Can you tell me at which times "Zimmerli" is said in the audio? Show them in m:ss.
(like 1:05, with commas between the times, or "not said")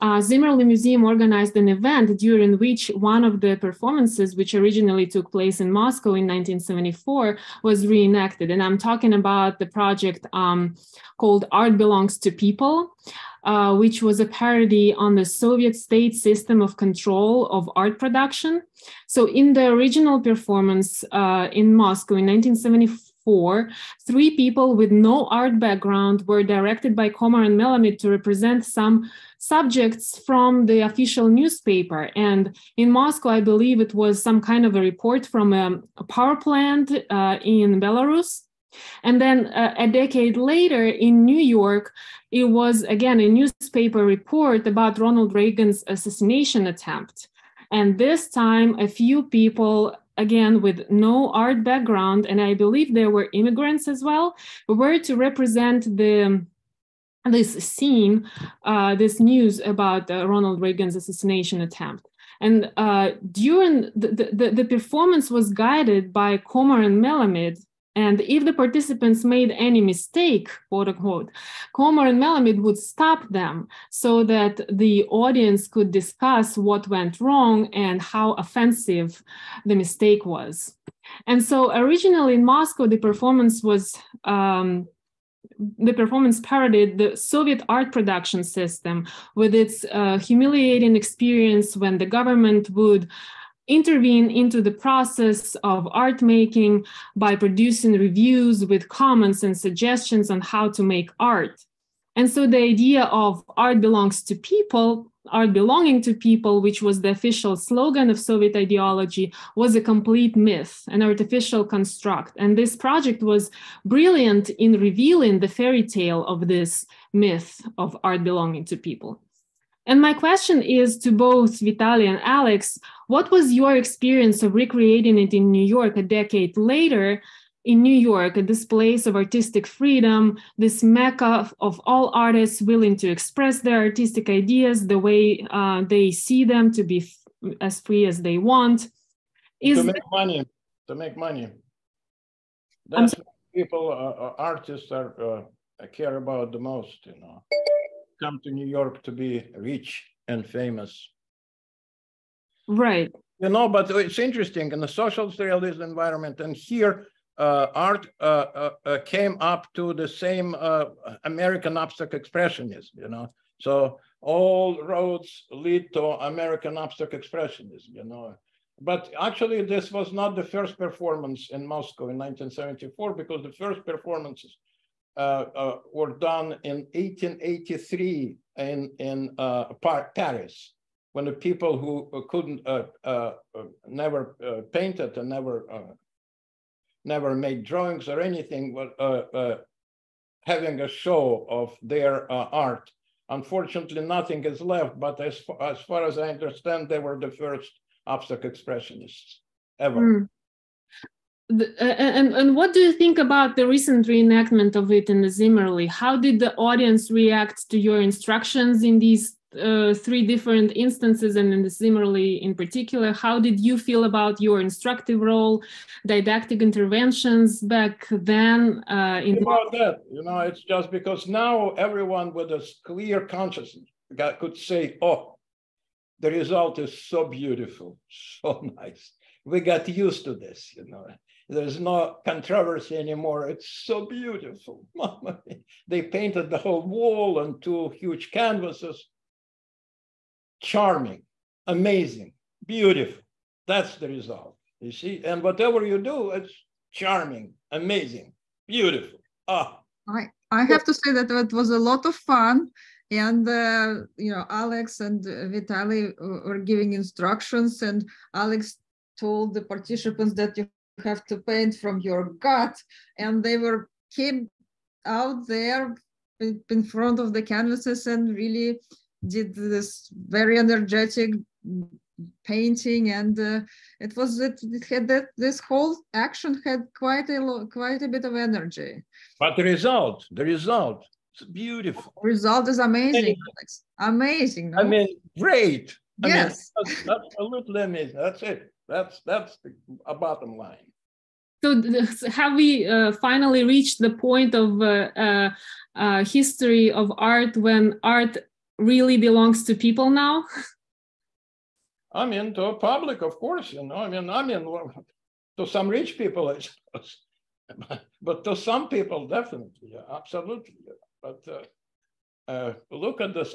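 0:00, 3:25, 3:31.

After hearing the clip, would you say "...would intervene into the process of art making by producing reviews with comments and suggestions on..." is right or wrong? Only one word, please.
right.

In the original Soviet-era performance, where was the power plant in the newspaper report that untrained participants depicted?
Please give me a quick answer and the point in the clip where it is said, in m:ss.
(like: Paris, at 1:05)
Belarus, at 0:37.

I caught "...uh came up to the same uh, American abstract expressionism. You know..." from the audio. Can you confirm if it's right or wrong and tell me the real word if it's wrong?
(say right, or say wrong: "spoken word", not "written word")
right.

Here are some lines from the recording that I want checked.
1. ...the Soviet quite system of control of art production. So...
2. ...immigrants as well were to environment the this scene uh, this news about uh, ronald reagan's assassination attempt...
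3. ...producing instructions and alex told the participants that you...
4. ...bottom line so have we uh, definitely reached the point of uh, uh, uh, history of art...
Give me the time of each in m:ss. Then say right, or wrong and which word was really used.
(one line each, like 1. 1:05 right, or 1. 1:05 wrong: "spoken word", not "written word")
1. 0:15 wrong: "state", not "quite"
2. 0:53 wrong: "represent", not "environment"
3. 4:16 wrong: "giving", not "producing"
4. 4:50 wrong: "finally", not "definitely".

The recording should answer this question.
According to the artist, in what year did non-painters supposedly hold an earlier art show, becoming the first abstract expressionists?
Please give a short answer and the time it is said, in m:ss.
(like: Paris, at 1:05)
1883, at 2:56.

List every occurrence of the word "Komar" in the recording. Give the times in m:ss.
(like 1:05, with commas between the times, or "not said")
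0:27, 1:06, 1:11.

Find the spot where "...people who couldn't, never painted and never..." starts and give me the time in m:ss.
3:01.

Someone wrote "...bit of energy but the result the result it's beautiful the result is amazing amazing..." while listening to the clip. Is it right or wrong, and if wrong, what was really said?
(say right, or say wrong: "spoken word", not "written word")
right.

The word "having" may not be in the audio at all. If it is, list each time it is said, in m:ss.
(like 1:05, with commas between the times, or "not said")
3:10.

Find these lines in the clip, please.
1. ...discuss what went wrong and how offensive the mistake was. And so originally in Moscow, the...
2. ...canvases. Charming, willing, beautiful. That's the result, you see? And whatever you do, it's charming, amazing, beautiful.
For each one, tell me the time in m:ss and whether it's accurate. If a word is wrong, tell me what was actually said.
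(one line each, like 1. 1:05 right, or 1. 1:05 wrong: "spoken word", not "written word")
1. 1:15 right
2. 3:58 wrong: "amazing", not "willing".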